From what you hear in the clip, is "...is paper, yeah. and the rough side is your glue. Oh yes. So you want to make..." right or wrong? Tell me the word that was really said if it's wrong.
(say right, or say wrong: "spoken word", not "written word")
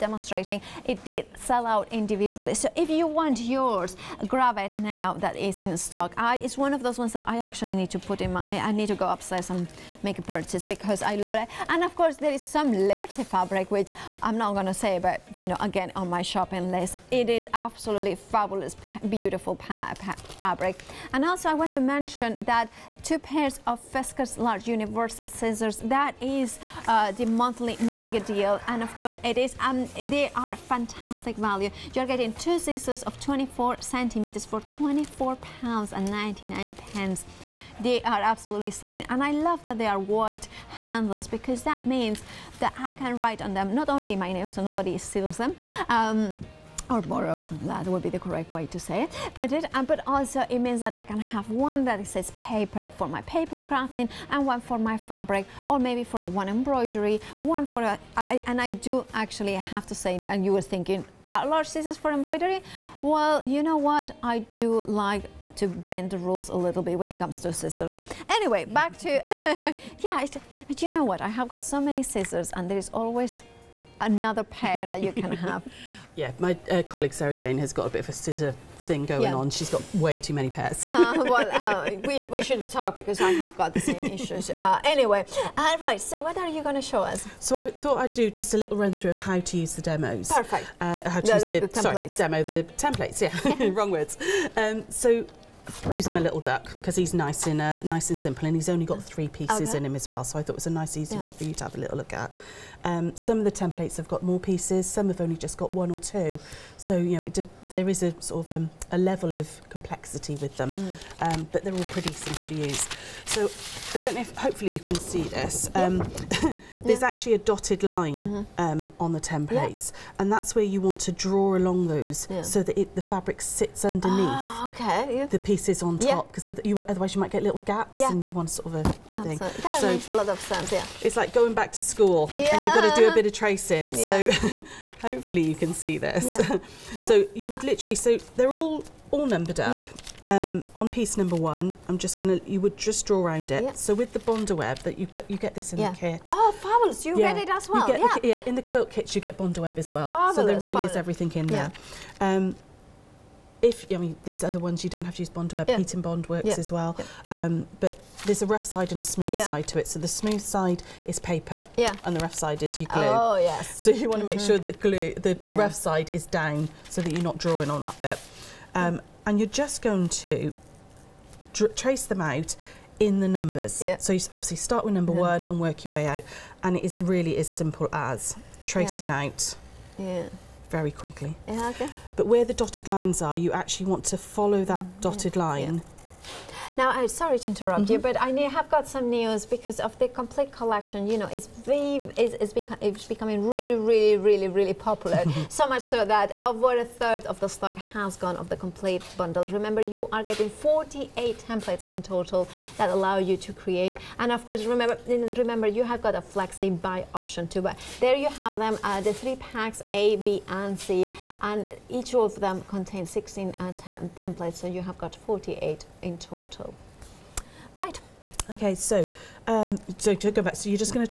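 right.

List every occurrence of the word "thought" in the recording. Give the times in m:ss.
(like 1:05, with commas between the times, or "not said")
1:27, 1:40.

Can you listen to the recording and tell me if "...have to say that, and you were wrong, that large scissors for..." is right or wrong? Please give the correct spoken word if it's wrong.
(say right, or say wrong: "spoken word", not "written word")
wrong: "thinking", not "wrong".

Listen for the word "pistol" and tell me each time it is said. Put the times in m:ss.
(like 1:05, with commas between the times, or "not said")
not said.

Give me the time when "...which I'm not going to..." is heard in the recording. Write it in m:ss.
0:13.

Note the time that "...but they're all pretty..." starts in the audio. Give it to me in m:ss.
1:51.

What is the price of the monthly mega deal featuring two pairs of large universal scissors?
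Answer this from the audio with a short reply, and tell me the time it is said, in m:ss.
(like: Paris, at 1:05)
£24.99, at 0:34.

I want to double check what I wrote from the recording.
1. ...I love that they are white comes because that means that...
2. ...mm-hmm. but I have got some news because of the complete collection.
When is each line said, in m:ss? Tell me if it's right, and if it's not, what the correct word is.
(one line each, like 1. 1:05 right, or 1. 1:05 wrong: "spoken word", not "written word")
1. 0:39 wrong: "handles", not "comes"
2. 3:07 right.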